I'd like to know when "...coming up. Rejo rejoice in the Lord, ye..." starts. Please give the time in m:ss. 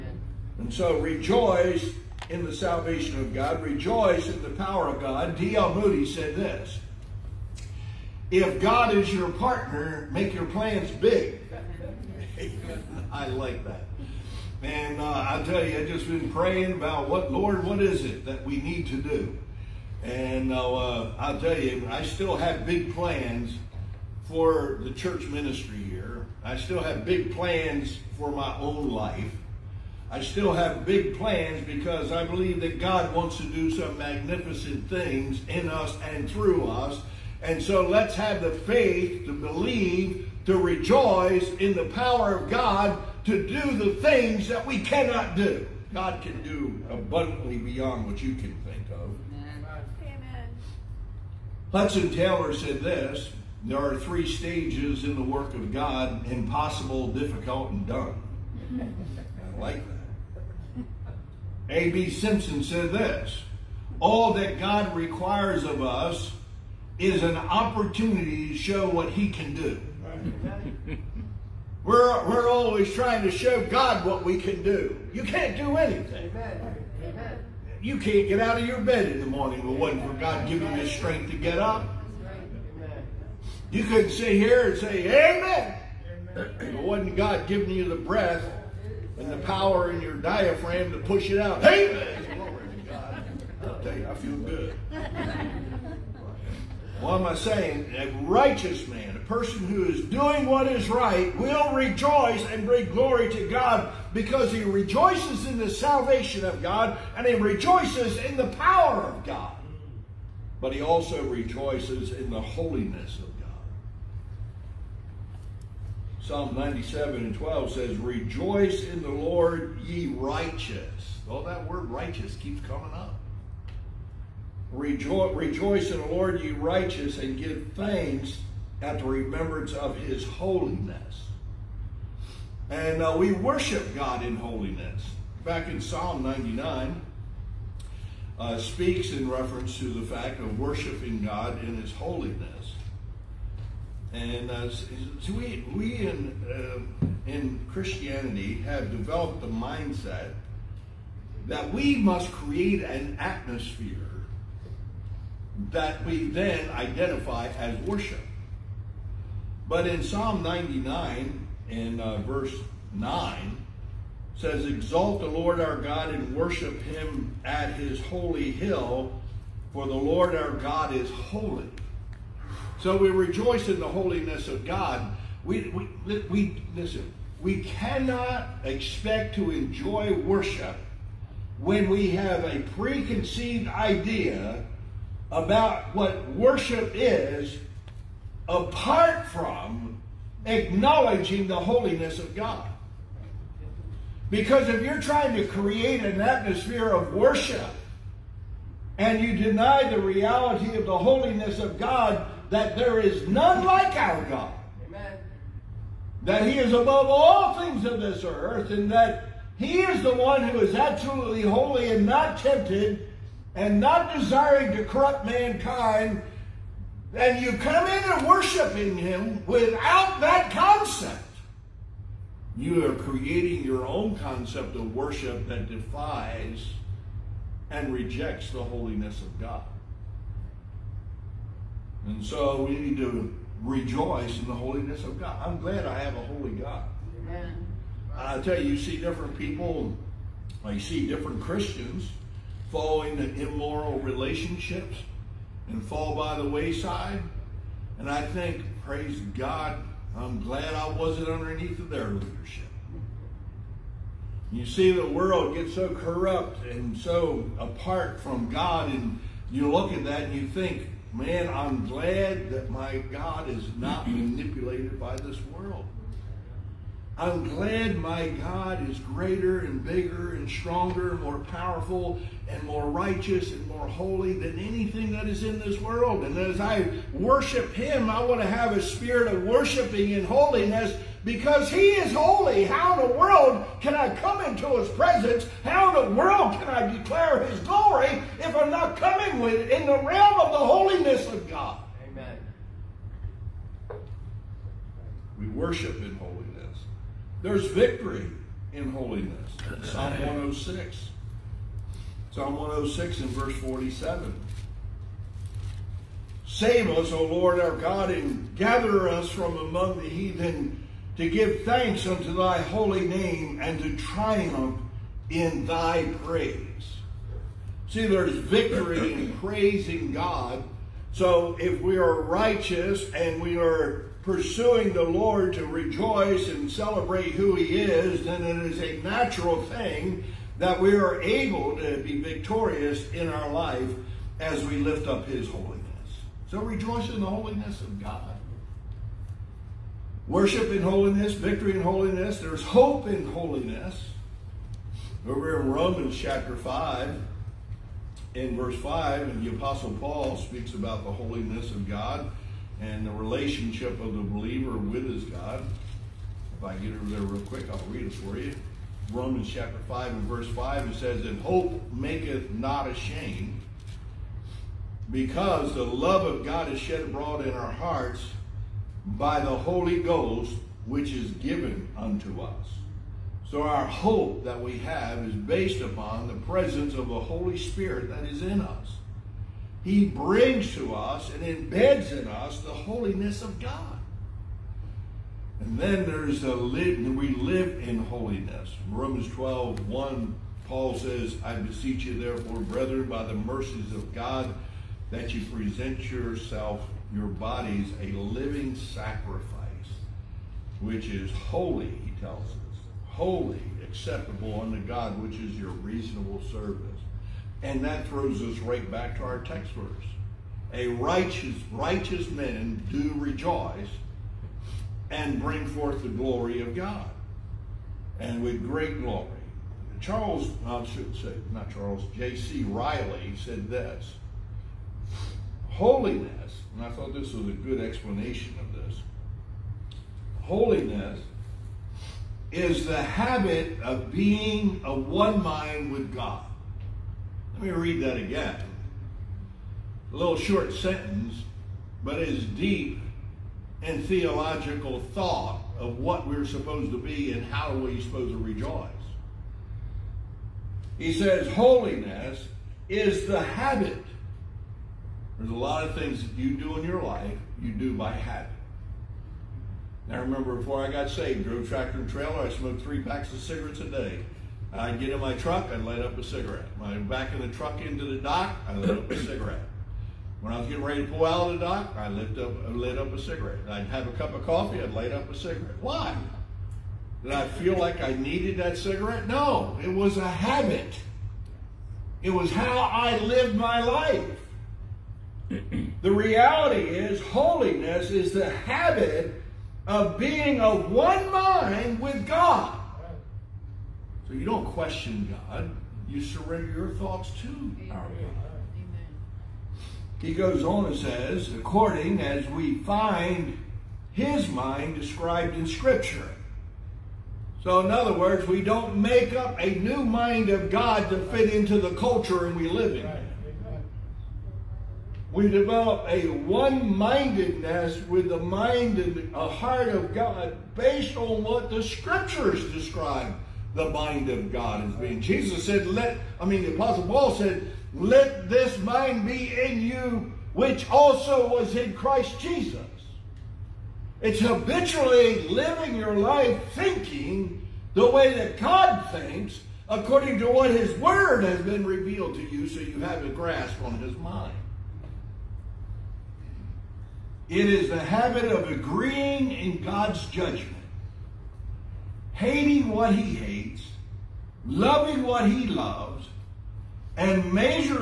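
2:02.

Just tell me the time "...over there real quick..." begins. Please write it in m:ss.
5:56.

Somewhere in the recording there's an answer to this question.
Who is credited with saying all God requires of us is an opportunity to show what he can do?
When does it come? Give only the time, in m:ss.
1:01.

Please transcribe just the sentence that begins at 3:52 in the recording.
And so we need to rejoice in the holiness of God.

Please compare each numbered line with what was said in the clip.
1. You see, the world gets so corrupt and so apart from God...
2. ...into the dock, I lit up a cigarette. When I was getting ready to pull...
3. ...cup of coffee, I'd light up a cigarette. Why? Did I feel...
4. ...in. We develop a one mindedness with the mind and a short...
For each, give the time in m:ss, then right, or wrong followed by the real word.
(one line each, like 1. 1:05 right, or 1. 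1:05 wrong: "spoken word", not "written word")
1. 4:14 right
2. 7:47 right
3. 7:54 right
4. 8:32 wrong: "heart", not "short".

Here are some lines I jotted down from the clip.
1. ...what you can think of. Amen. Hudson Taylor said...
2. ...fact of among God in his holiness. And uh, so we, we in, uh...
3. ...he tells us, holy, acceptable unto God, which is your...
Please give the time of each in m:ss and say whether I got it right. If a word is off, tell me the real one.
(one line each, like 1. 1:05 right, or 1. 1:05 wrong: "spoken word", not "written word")
1. 0:48 right
2. 2:20 wrong: "worshiping", not "among"
3. 6:42 right.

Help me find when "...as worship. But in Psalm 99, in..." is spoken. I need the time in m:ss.
2:37.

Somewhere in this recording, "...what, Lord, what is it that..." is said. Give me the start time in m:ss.
0:17.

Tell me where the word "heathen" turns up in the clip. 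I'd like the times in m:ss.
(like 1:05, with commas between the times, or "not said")
5:10.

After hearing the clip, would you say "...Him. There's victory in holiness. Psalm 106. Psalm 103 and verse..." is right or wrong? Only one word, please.
wrong.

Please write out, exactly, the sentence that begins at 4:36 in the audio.
And as I worship Him, I want to have a spirit of worshiping and holiness because He is holy.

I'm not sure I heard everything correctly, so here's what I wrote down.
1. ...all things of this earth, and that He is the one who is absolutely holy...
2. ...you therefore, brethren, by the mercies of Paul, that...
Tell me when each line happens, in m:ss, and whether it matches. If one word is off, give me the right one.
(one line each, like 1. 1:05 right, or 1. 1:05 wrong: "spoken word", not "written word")
1. 3:27 right
2. 6:32 wrong: "God", not "Paul".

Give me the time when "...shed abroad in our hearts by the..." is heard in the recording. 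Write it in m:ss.
6:06.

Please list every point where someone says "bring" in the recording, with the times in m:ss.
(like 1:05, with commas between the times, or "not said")
1:42, 6:20, 6:55.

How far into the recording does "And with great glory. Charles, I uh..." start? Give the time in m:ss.
6:58.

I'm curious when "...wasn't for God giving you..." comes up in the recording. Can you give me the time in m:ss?
1:19.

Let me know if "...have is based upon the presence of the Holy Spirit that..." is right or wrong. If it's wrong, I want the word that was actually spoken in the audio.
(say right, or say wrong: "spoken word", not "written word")
right.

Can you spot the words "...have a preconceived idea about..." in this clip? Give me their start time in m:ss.
3:02.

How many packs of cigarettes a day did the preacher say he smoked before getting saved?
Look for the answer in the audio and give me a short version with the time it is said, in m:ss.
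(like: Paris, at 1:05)
3, at 7:42.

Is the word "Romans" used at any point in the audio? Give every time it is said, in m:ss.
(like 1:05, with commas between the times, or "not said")
5:45, 5:59, 6:28.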